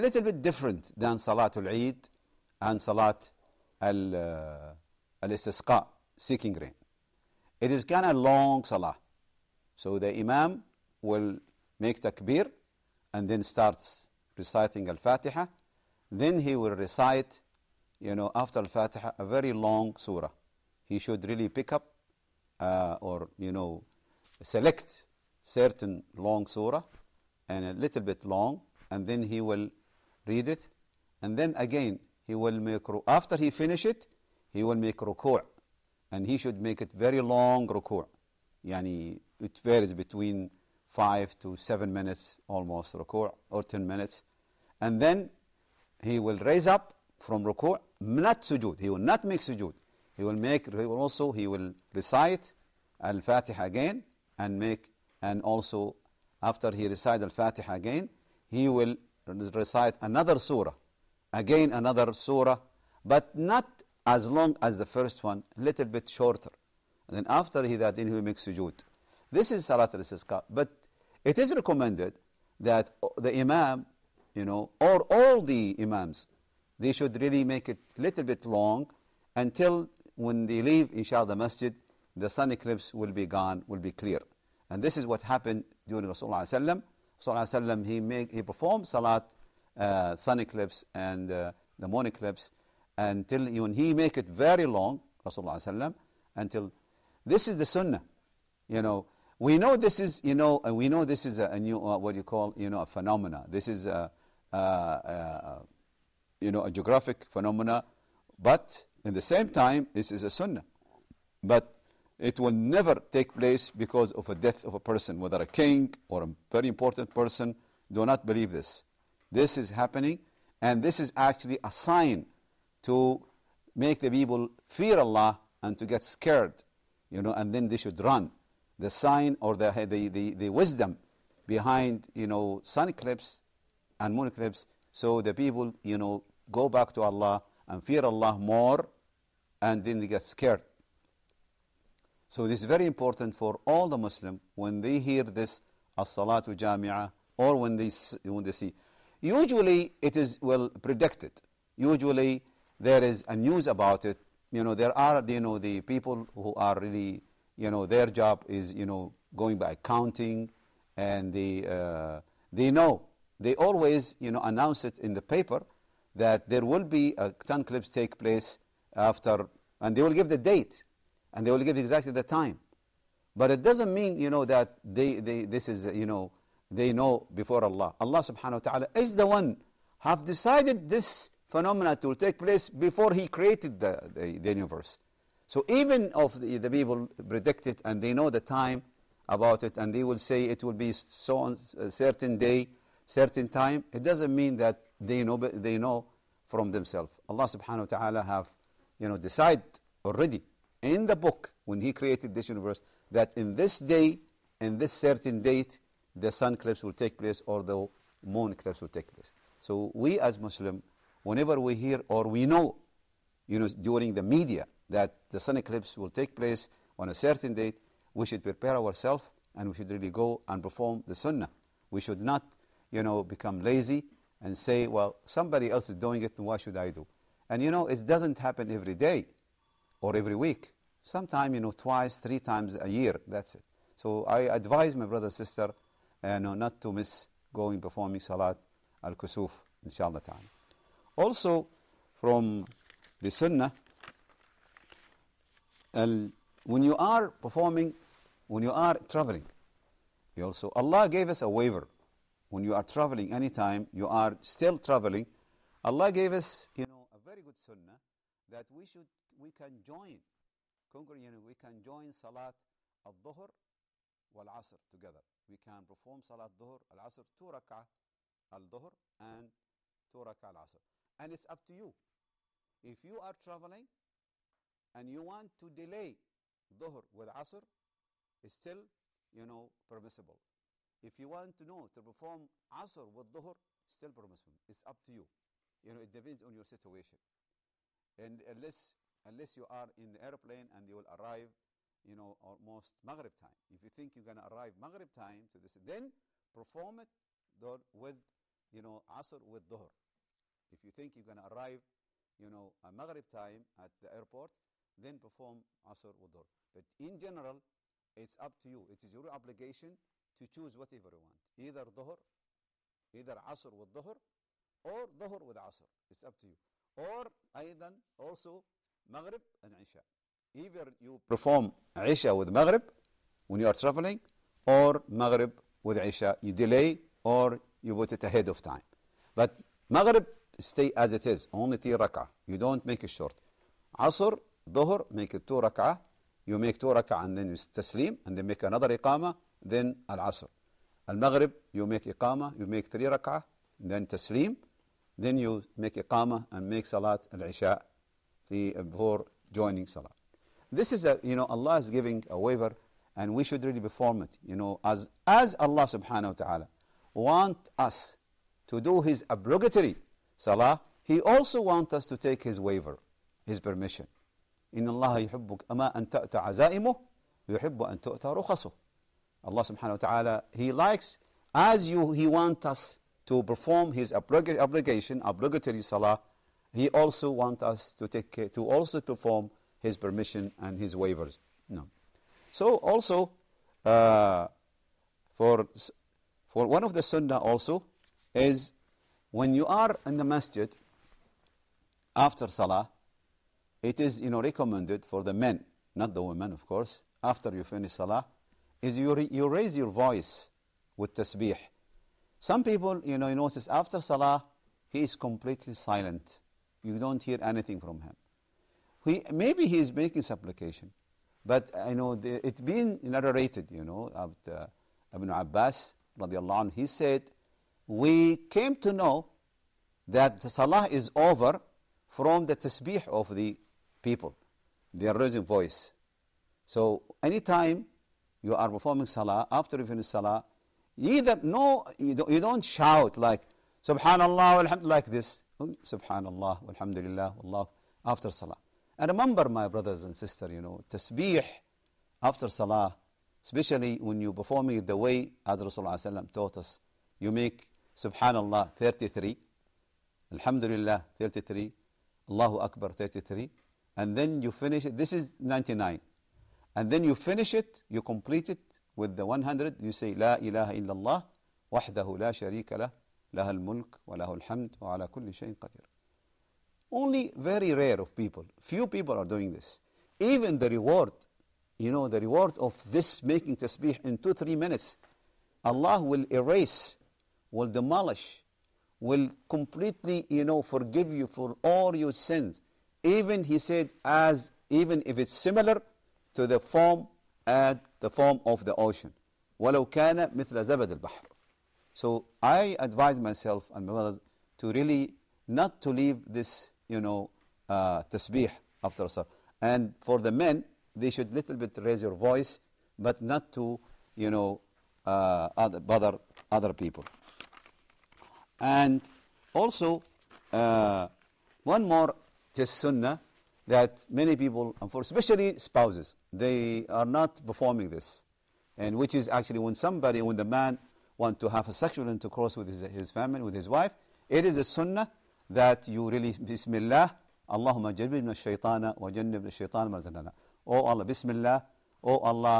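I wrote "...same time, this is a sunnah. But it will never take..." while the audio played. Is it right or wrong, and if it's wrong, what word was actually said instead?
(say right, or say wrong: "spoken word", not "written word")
right.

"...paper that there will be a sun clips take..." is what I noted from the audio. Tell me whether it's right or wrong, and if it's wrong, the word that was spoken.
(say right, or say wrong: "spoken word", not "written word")
right.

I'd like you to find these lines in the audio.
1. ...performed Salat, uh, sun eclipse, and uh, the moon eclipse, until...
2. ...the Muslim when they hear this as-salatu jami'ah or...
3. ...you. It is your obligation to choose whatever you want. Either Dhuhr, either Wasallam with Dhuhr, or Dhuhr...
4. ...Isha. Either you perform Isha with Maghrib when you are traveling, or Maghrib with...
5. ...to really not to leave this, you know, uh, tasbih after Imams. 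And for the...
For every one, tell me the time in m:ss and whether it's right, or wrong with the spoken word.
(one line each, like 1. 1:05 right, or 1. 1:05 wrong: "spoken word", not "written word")
1. 1:28 right
2. 2:23 right
3. 5:08 wrong: "Asr", not "Wasallam"
4. 5:19 right
5. 8:14 wrong: "Salah", not "Imams".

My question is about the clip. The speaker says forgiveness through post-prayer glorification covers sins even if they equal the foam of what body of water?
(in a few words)
the ocean.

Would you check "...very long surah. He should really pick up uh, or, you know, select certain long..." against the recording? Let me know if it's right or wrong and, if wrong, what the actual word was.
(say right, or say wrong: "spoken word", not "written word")
right.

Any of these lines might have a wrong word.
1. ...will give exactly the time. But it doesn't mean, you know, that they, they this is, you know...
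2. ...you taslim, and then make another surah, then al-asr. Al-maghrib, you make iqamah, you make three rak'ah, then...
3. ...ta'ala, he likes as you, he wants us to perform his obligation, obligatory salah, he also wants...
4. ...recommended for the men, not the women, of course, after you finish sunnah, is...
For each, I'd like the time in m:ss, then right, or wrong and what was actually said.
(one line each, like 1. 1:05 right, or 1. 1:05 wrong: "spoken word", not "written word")
1. 2:51 right
2. 5:37 wrong: "iqamah", not "surah"
3. 6:09 right
4. 6:34 wrong: "salah", not "sunnah".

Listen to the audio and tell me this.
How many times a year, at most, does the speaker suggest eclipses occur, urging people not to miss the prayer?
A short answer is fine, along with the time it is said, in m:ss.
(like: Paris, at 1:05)
3 times, at 3:52.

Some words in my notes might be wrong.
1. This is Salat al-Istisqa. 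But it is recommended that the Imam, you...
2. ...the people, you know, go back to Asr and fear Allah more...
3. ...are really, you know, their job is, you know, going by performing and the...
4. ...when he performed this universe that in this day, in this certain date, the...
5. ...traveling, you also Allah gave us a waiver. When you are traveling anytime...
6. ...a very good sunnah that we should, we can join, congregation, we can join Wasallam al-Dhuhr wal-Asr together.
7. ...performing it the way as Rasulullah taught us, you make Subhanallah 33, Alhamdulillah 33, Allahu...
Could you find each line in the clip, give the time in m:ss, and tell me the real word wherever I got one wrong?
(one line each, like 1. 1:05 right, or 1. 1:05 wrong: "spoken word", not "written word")
1. 1:09 right
2. 2:15 wrong: "Allah", not "Asr"
3. 2:36 wrong: "counting", not "performing"
4. 3:21 wrong: "created", not "performed"
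5. 4:09 right
6. 4:17 wrong: "Salat", not "Wasallam"
7. 7:24 right.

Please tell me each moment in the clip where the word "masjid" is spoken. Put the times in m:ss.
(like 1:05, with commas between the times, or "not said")
1:21, 6:30.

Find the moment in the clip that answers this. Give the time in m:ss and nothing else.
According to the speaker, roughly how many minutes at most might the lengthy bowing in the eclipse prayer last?
0:43.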